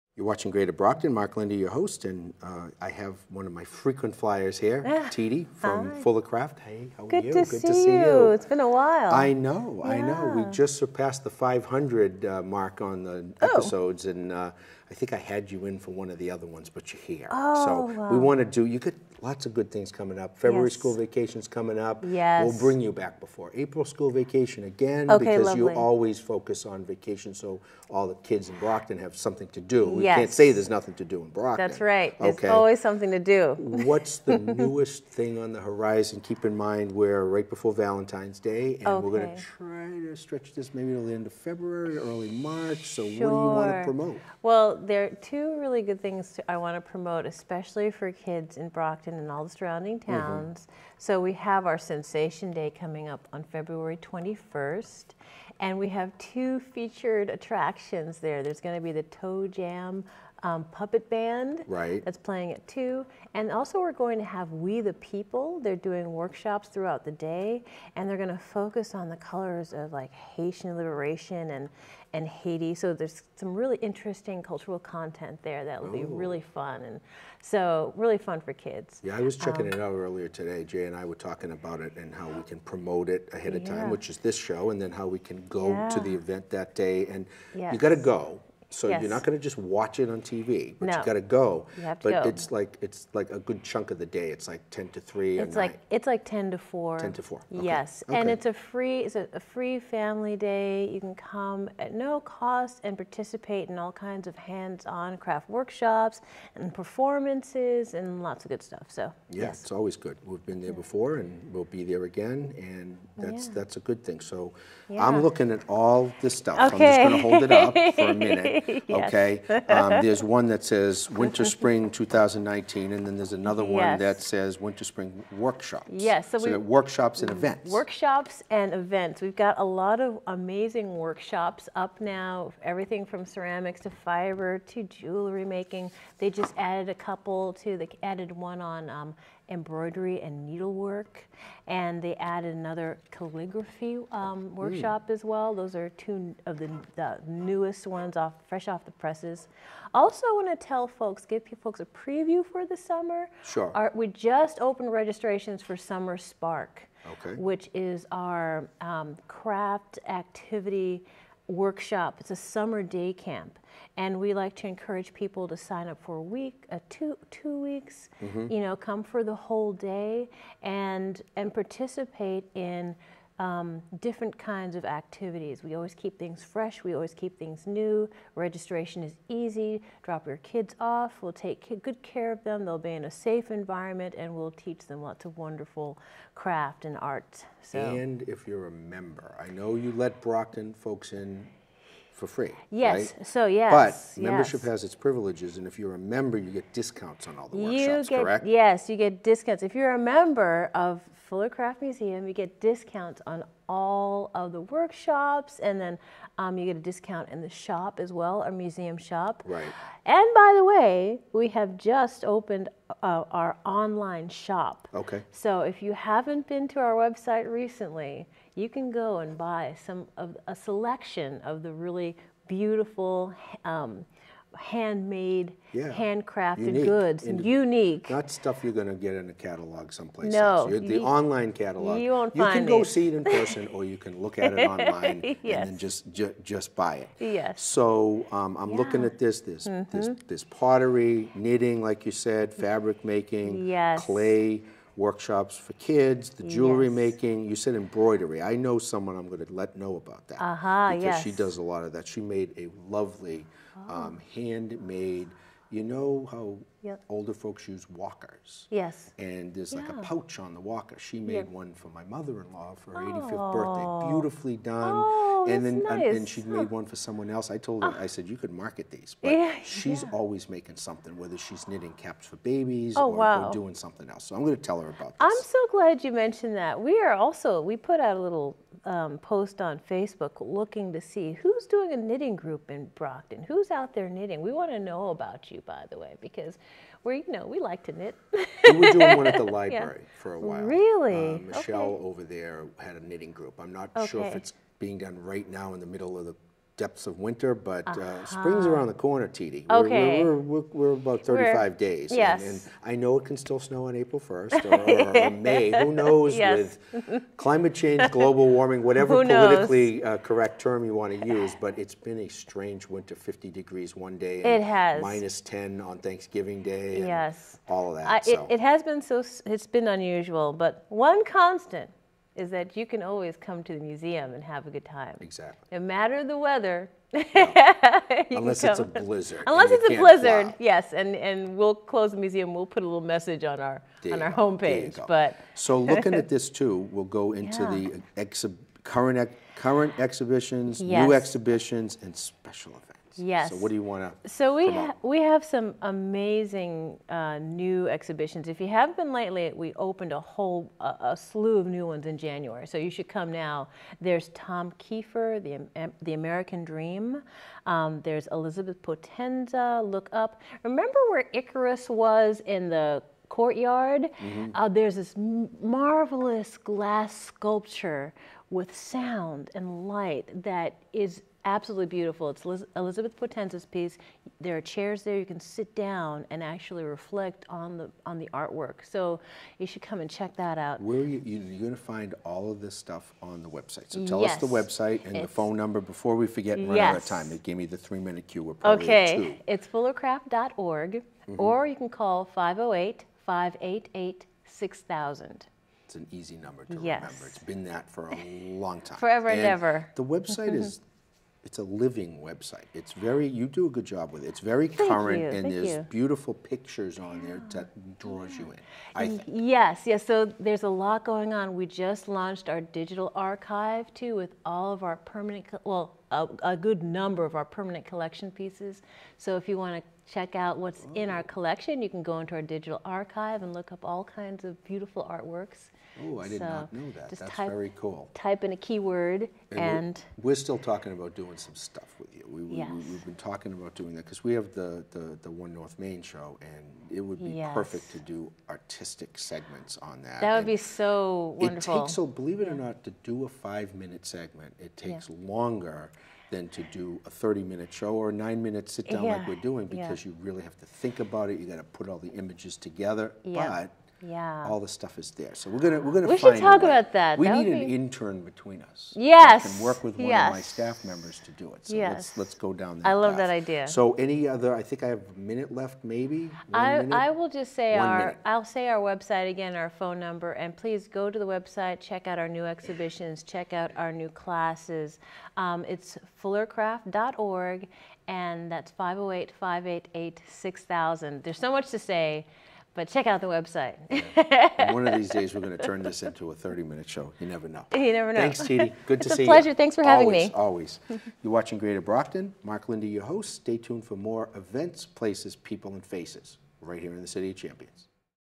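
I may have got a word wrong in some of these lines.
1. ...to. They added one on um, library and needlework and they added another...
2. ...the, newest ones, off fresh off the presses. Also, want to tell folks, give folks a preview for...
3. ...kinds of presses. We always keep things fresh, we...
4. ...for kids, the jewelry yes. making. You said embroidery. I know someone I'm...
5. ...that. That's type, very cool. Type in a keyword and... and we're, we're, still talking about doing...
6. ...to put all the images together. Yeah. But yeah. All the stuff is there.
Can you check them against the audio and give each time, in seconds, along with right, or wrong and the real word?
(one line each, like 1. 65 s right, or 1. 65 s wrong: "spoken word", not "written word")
1. 137 s wrong: "embroidery", not "library"
2. 146 s right
3. 174 s wrong: "activities", not "presses"
4. 245 s right
5. 426 s right
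6. 451 s right.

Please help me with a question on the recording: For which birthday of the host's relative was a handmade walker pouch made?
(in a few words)
85th.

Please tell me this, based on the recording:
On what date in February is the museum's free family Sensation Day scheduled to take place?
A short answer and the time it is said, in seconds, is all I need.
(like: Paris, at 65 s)
February 21st, at 53 s.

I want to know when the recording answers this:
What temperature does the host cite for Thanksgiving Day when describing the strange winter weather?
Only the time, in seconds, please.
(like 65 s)
315 s.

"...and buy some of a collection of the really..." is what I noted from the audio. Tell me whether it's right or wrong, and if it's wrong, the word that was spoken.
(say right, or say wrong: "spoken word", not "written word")
wrong: "selection", not "collection".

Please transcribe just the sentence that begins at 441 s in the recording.
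It takes, so believe it or not, to do a five minute segment, it takes yeah.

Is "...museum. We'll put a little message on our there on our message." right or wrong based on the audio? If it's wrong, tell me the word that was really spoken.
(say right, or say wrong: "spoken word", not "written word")
wrong: "homepage", not "message".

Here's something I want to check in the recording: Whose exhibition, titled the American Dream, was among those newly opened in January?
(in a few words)
Tom Kiefer.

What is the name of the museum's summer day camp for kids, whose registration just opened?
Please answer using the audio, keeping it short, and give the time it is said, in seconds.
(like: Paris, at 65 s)
Summer Spark, at 155 s.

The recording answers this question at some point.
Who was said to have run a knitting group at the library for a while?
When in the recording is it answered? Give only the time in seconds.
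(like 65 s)
291 s.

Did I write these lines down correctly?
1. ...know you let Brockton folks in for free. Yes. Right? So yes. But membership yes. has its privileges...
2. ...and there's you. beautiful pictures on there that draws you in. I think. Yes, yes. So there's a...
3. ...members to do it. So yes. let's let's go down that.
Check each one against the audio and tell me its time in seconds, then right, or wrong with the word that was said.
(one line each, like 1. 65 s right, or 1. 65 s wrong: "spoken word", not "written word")
1. 189 s right
2. 405 s right
3. 460 s right.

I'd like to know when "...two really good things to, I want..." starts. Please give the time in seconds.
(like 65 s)
45 s.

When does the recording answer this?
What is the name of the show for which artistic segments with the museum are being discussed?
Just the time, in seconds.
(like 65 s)
435 s.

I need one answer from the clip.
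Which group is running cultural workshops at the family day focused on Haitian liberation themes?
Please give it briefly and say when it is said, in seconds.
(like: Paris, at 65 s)
We the People, at 64 s.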